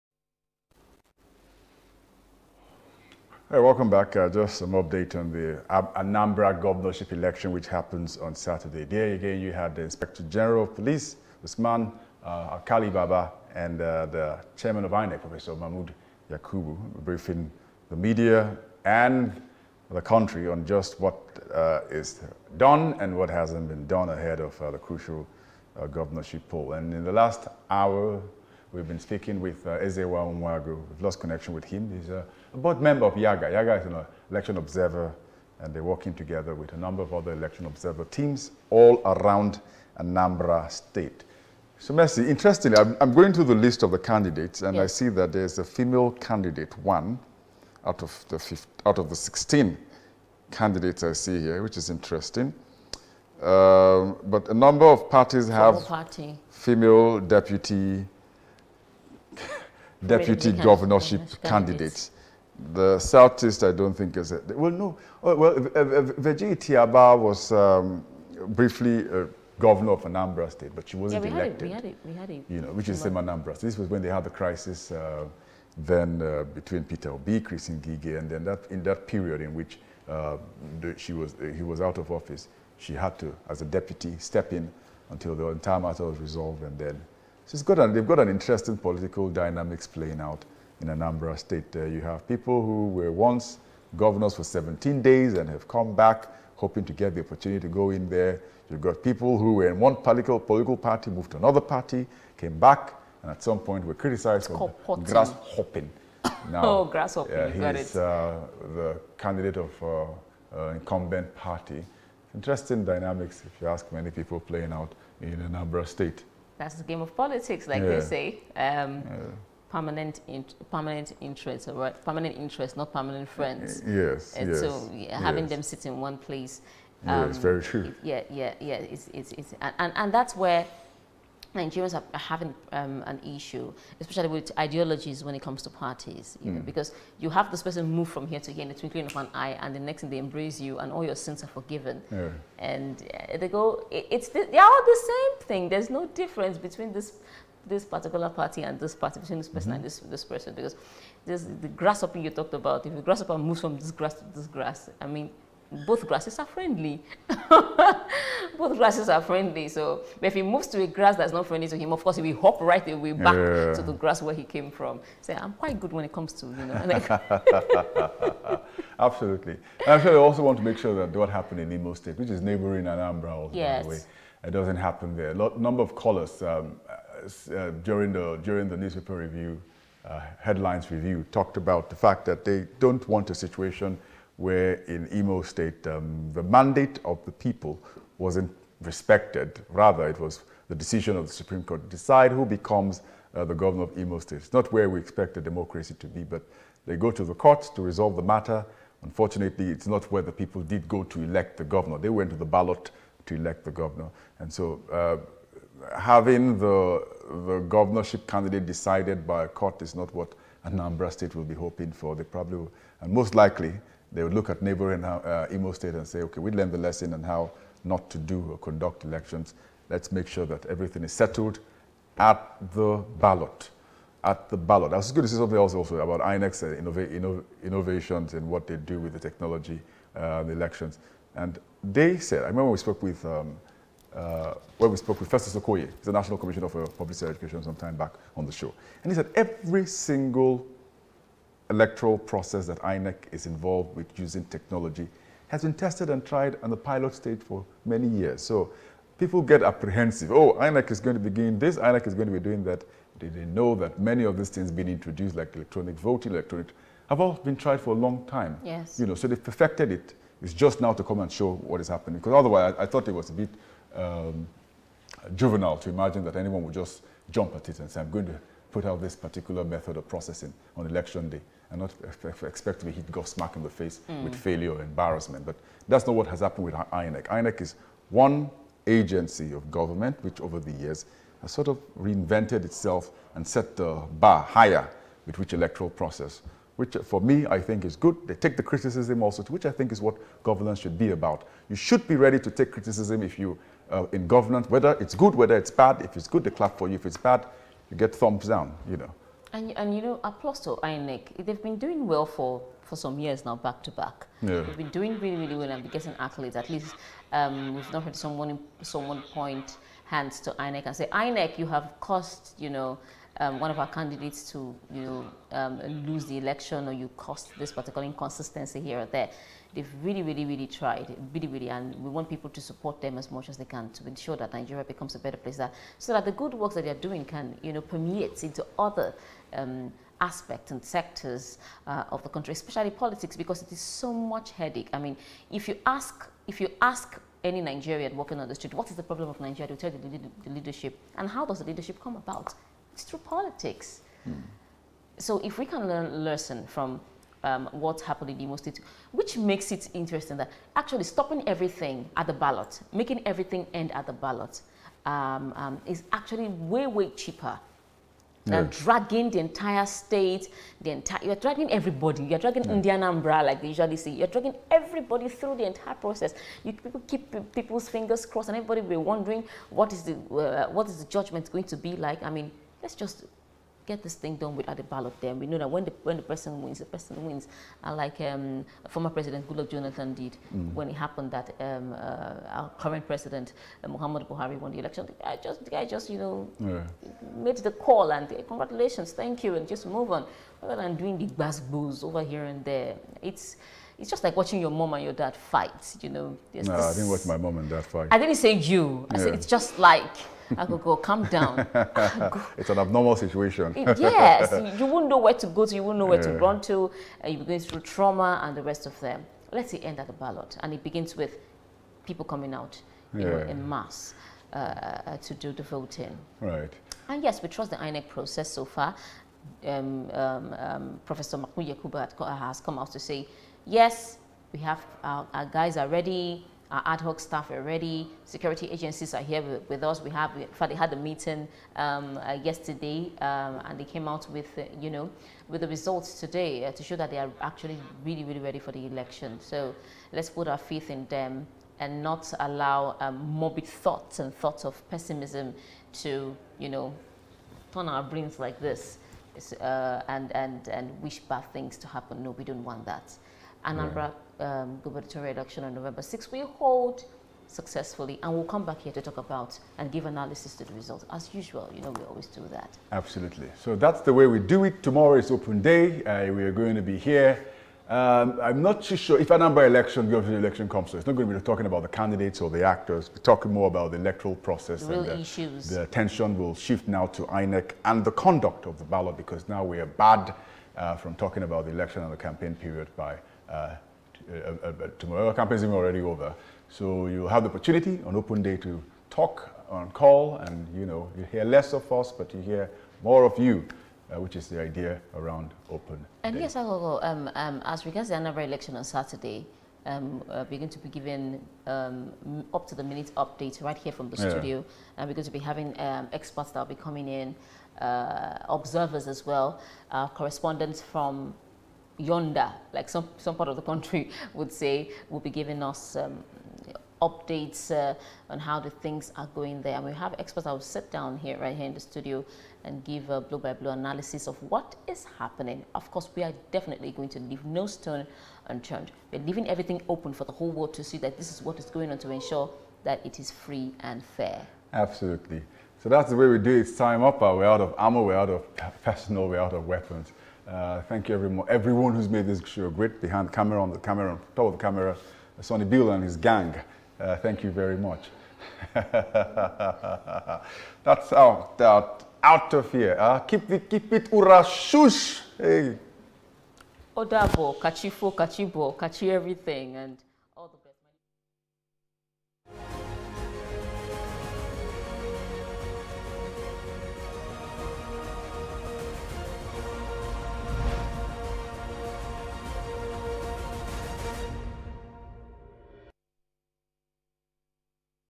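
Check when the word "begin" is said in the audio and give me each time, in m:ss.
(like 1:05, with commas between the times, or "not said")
4:11, 6:50.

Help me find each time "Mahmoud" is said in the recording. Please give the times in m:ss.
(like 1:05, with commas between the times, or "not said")
0:15, 7:01.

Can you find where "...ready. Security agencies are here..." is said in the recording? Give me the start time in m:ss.
7:07.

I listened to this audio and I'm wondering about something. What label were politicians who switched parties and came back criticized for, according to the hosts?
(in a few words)
grasshopping.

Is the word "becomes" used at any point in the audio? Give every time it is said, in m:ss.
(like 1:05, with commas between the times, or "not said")
3:12, 5:24.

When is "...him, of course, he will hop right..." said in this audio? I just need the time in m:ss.
2:41.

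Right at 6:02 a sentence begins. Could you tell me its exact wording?
Ndi Anambra like they usually say, you're dragging everybody through the entire process.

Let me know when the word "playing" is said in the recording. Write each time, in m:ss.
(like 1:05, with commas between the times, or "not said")
1:29, 1:54.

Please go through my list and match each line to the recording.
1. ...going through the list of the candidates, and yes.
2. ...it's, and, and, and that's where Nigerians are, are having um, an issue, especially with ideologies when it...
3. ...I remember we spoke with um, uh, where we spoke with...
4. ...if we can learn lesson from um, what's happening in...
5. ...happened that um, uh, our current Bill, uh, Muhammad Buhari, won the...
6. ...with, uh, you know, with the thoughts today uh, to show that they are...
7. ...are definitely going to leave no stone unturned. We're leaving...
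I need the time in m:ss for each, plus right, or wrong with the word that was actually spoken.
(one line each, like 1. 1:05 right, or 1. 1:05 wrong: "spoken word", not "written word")
1. 0:43 right
2. 2:09 right
3. 3:52 right
4. 5:45 right
5. 6:20 wrong: "President", not "Bill"
6. 7:14 wrong: "results", not "thoughts"
7. 8:46 right.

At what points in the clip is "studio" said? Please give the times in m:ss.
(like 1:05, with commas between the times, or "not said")
8:24, 8:41.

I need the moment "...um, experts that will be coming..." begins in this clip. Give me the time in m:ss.
8:25.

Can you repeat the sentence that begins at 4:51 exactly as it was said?
You should be ready to take criticism if you uh, in government, whether it's good, whether it's bad.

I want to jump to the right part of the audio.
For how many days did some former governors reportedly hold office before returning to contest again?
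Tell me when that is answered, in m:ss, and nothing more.
1:34.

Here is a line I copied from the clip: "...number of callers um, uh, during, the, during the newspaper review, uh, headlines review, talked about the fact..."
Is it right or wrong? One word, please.
right.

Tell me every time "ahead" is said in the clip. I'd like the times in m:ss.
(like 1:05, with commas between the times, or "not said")
0:24.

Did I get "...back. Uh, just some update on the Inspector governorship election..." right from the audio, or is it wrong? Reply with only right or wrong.
wrong.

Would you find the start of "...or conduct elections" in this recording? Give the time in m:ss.
3:38.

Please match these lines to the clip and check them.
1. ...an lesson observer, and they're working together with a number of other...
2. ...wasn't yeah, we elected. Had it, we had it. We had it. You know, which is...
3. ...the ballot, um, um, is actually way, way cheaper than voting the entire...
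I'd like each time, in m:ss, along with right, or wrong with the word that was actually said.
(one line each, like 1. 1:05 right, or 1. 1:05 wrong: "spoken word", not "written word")
1. 0:33 wrong: "election", not "lesson"
2. 1:10 right
3. 5:54 wrong: "dragging", not "voting".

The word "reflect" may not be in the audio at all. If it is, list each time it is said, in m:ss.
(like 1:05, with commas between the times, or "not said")
not said.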